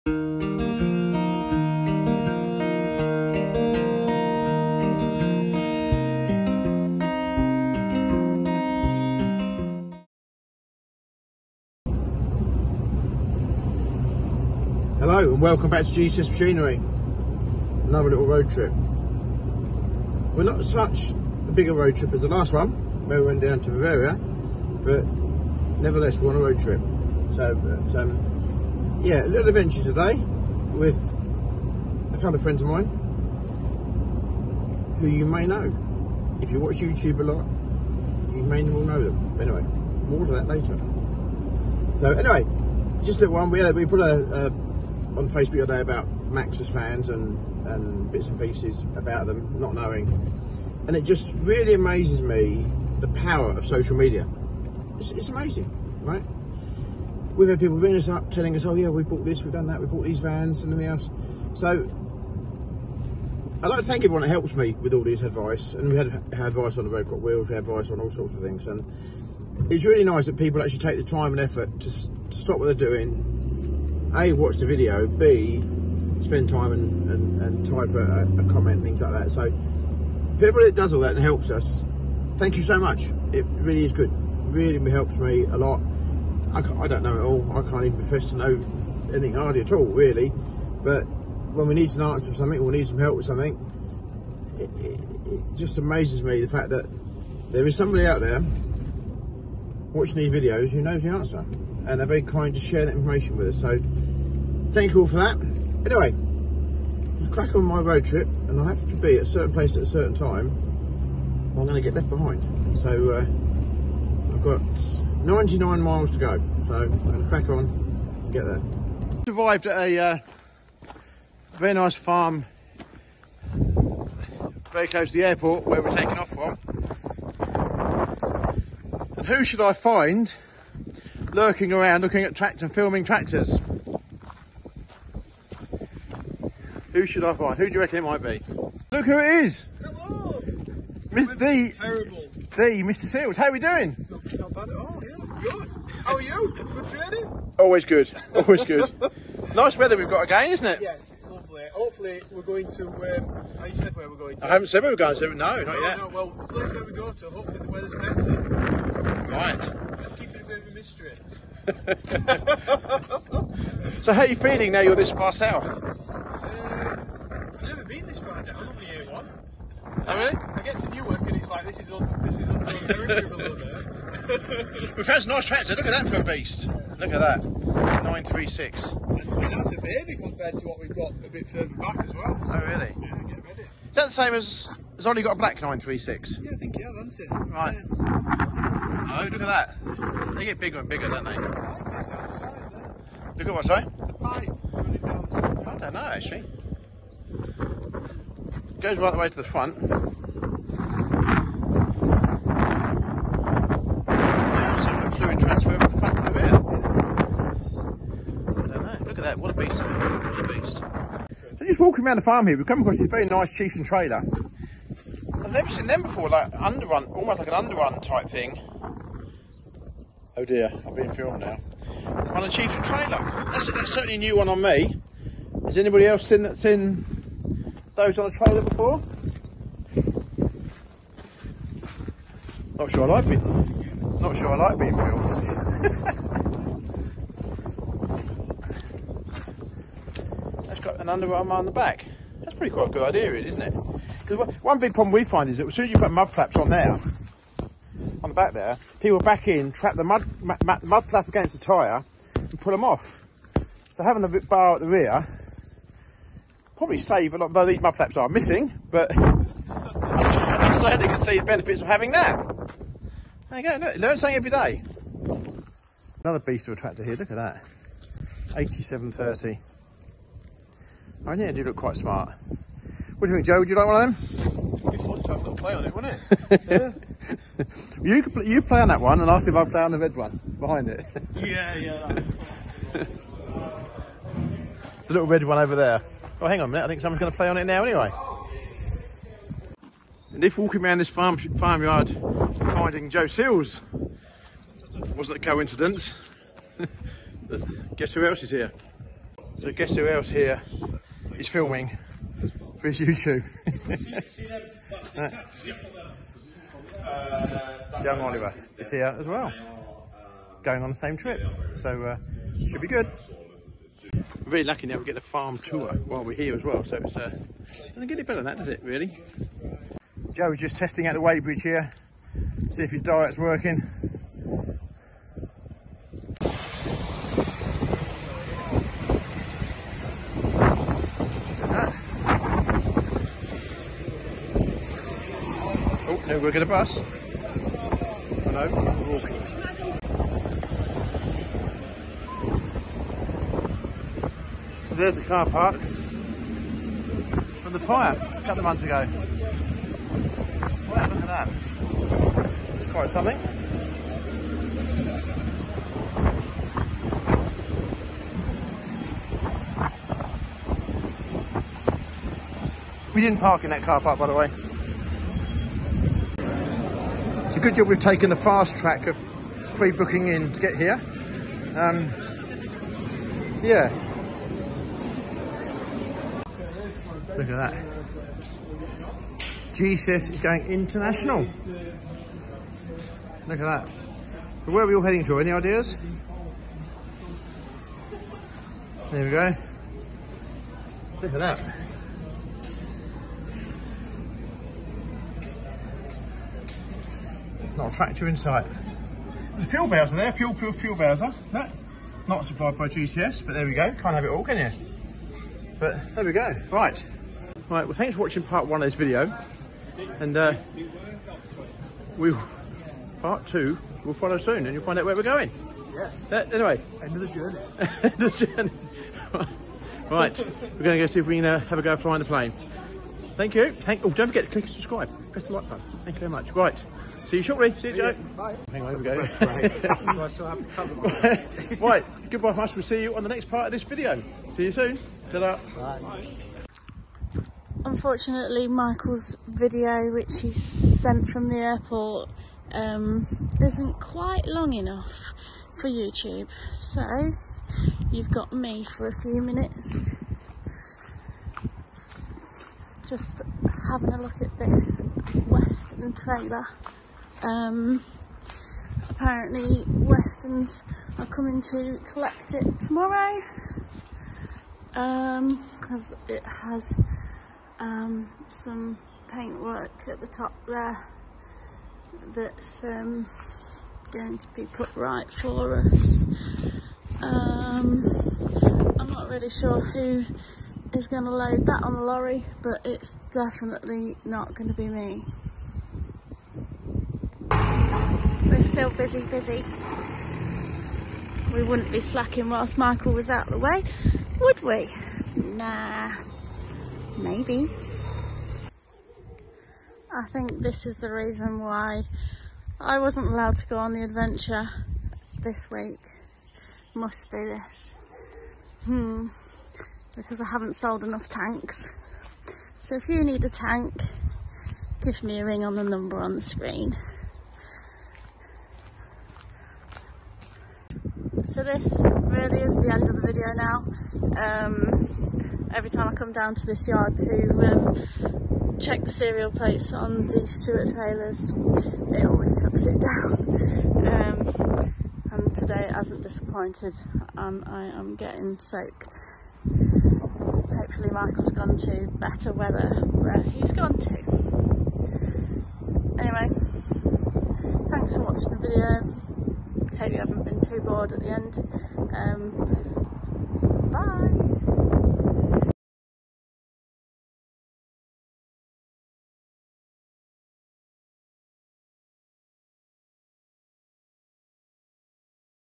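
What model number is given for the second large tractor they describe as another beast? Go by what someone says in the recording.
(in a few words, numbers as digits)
8730.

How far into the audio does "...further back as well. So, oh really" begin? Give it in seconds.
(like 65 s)
181 s.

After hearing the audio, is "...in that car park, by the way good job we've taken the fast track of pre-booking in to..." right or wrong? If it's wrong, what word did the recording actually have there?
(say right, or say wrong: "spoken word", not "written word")
right.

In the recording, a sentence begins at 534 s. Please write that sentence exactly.
Um, and today it hasn't disappointed and I am getting soaked hopefully Michael's gone to better weather where he's gone to.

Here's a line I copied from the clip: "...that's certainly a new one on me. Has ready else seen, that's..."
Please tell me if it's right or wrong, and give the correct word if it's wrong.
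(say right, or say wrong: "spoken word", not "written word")
wrong: "anybody", not "ready".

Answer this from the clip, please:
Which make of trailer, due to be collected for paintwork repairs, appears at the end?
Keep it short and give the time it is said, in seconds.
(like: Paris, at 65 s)
Western, at 455 s.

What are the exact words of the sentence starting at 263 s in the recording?
There you go, look, learn something every day.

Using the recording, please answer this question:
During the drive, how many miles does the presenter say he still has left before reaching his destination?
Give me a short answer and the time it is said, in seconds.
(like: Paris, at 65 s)
99, at 115 s.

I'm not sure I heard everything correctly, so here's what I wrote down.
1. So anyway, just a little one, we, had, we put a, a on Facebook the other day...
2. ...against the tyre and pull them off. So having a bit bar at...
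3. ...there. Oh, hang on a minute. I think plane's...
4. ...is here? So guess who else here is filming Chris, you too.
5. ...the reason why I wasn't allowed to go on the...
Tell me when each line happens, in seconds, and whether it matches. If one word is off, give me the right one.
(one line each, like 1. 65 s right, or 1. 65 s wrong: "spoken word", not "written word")
1. 41 s right
2. 251 s right
3. 285 s wrong: "someone", not "plane"
4. 298 s right
5. 500 s right.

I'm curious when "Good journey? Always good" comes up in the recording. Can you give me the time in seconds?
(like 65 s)
146 s.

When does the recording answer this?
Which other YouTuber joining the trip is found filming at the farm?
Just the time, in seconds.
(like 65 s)
308 s.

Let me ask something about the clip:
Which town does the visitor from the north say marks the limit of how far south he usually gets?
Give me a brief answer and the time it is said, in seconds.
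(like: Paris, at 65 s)
Newark, at 170 s.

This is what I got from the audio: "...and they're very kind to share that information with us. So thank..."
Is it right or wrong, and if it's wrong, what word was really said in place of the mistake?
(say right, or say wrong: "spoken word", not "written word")
right.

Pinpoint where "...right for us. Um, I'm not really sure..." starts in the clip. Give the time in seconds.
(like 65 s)
474 s.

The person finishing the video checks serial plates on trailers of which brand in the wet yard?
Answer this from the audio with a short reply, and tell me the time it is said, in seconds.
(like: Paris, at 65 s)
Stewart, at 530 s.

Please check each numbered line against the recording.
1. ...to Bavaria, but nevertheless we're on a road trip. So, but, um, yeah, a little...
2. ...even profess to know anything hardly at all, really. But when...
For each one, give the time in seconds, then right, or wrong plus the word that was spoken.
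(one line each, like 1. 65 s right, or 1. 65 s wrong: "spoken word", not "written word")
1. 23 s right
2. 87 s right.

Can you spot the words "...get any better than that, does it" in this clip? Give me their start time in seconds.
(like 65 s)
318 s.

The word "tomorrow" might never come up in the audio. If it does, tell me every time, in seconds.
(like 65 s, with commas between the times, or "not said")
462 s.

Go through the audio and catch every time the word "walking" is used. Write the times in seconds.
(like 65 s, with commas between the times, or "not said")
211 s, 290 s, 339 s.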